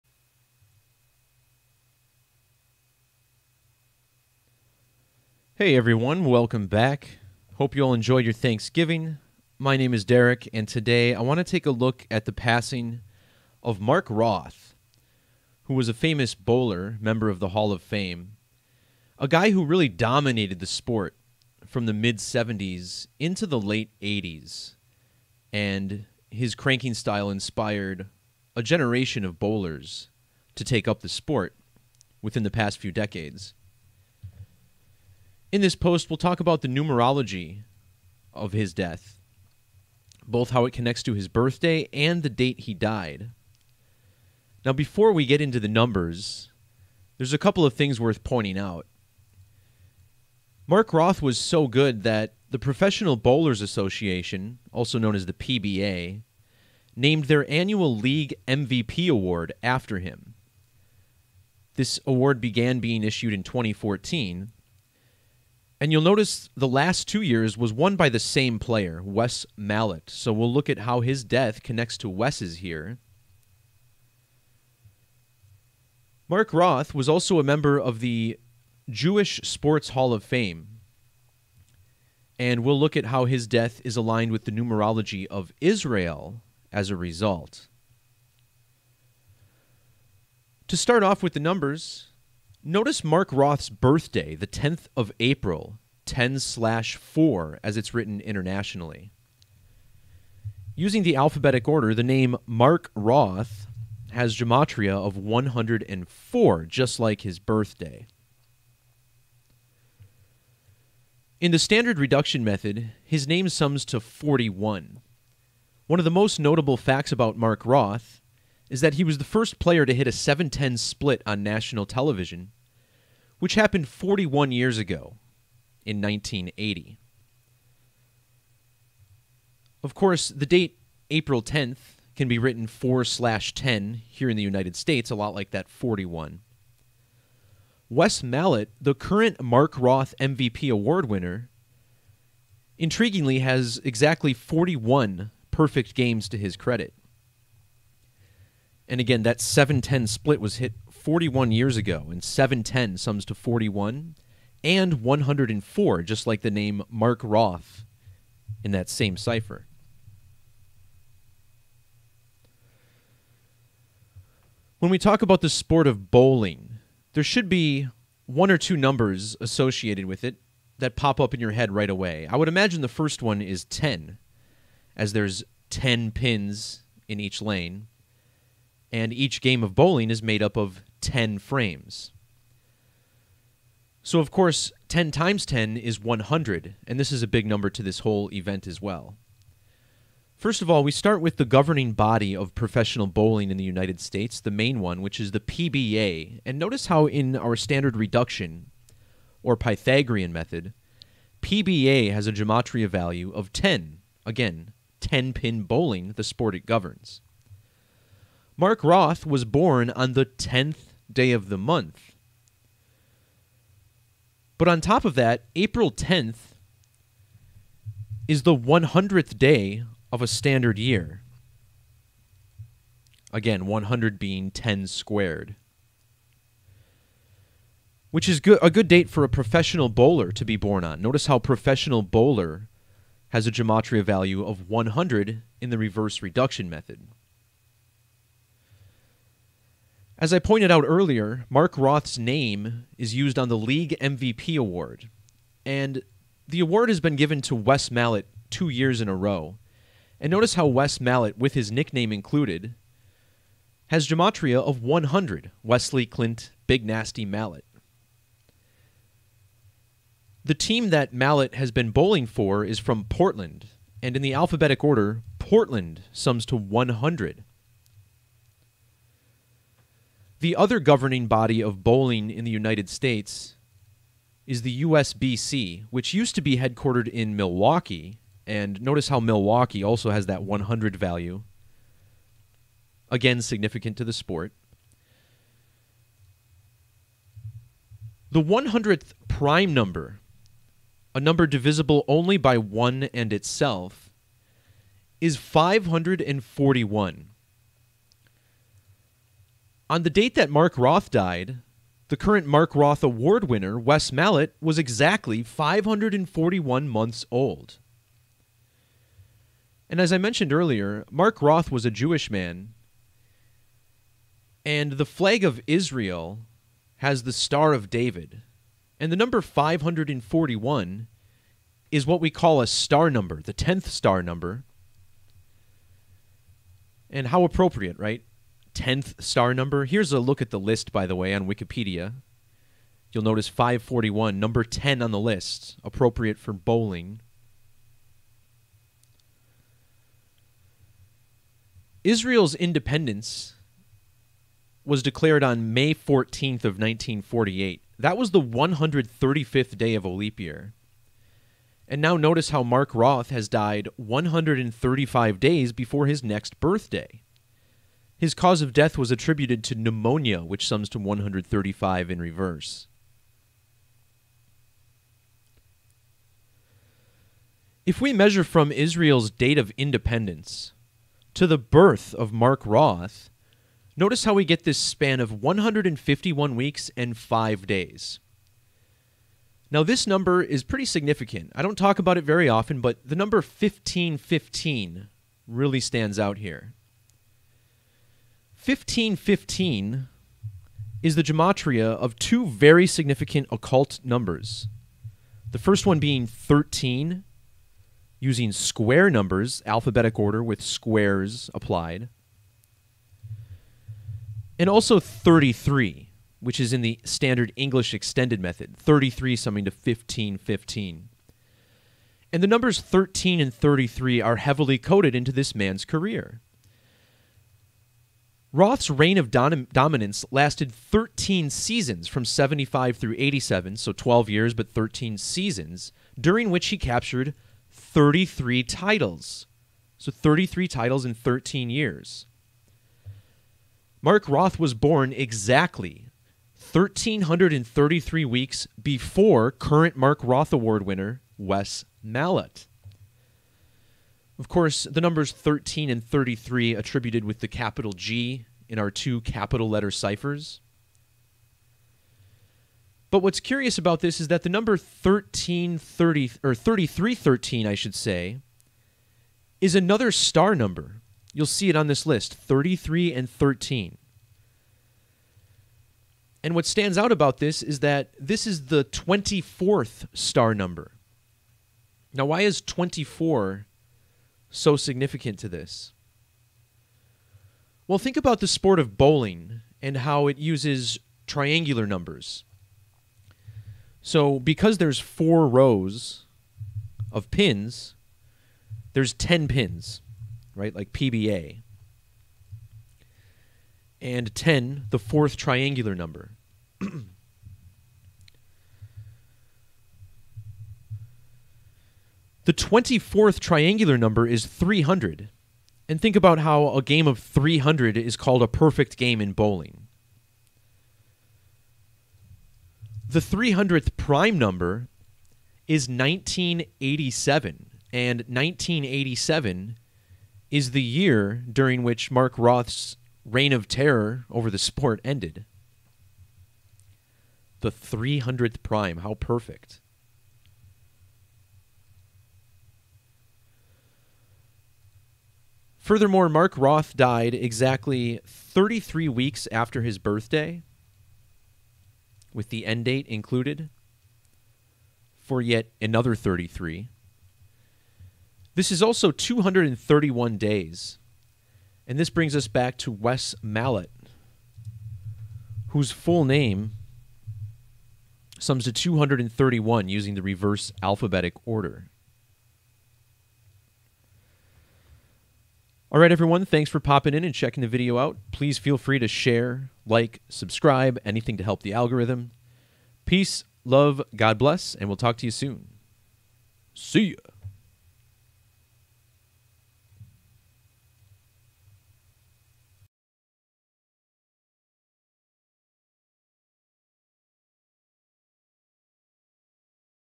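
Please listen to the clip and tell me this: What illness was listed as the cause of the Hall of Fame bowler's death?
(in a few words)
Pneumonia.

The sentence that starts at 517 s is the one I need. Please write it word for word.
And 1987 is the year during which Mark Roth's reign of terror over the sport ended.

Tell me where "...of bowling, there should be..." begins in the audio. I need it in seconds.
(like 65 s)
165 s.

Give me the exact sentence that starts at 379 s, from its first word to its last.
Now, this number is pretty significant.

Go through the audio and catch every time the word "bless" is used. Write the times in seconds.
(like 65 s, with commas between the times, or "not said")
574 s.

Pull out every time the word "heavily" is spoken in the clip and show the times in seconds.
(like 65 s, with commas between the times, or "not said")
414 s.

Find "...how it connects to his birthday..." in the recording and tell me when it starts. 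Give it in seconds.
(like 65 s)
40 s.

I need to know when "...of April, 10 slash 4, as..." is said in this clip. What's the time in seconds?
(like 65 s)
94 s.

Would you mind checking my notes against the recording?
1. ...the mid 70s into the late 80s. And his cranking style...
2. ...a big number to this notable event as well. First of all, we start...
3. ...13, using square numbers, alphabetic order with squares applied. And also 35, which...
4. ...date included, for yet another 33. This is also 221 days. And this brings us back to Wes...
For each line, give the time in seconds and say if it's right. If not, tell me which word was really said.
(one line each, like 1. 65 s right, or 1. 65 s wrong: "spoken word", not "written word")
1. 21 s right
2. 187 s wrong: "whole", not "notable"
3. 396 s wrong: "33", not "35"
4. 542 s wrong: "231", not "221".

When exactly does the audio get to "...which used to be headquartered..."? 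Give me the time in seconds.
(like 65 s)
275 s.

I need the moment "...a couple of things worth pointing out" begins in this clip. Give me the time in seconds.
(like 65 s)
47 s.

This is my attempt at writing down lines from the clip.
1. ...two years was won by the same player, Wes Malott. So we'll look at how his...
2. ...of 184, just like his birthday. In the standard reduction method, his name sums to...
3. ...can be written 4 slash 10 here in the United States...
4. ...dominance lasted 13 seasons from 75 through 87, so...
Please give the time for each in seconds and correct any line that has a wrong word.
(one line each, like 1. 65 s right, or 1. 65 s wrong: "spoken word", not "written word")
1. 67 s right
2. 104 s wrong: "104", not "184"
3. 132 s right
4. 419 s right.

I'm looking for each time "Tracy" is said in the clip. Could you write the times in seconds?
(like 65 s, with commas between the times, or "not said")
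not said.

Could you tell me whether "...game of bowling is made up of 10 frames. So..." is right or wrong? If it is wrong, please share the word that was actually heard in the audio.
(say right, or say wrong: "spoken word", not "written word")
right.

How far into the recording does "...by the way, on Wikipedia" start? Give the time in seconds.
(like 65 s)
330 s.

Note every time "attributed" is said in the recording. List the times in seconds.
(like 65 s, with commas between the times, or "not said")
359 s, 446 s.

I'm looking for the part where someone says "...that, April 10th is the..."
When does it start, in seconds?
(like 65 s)
215 s.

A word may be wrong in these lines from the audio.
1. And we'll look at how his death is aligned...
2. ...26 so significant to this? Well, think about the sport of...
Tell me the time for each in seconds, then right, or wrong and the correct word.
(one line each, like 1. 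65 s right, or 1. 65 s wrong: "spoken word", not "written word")
1. 82 s right
2. 472 s wrong: "24", not "26".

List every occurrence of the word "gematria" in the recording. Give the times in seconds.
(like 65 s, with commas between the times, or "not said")
104 s, 202 s, 233 s, 254 s, 391 s.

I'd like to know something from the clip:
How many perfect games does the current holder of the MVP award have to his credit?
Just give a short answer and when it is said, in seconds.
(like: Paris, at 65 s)
41, at 144 s.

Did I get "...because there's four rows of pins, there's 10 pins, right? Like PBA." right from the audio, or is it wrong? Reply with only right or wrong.
right.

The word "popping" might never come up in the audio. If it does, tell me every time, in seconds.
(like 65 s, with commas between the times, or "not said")
566 s.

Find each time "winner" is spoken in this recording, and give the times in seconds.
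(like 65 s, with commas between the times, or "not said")
141 s, 303 s, 440 s.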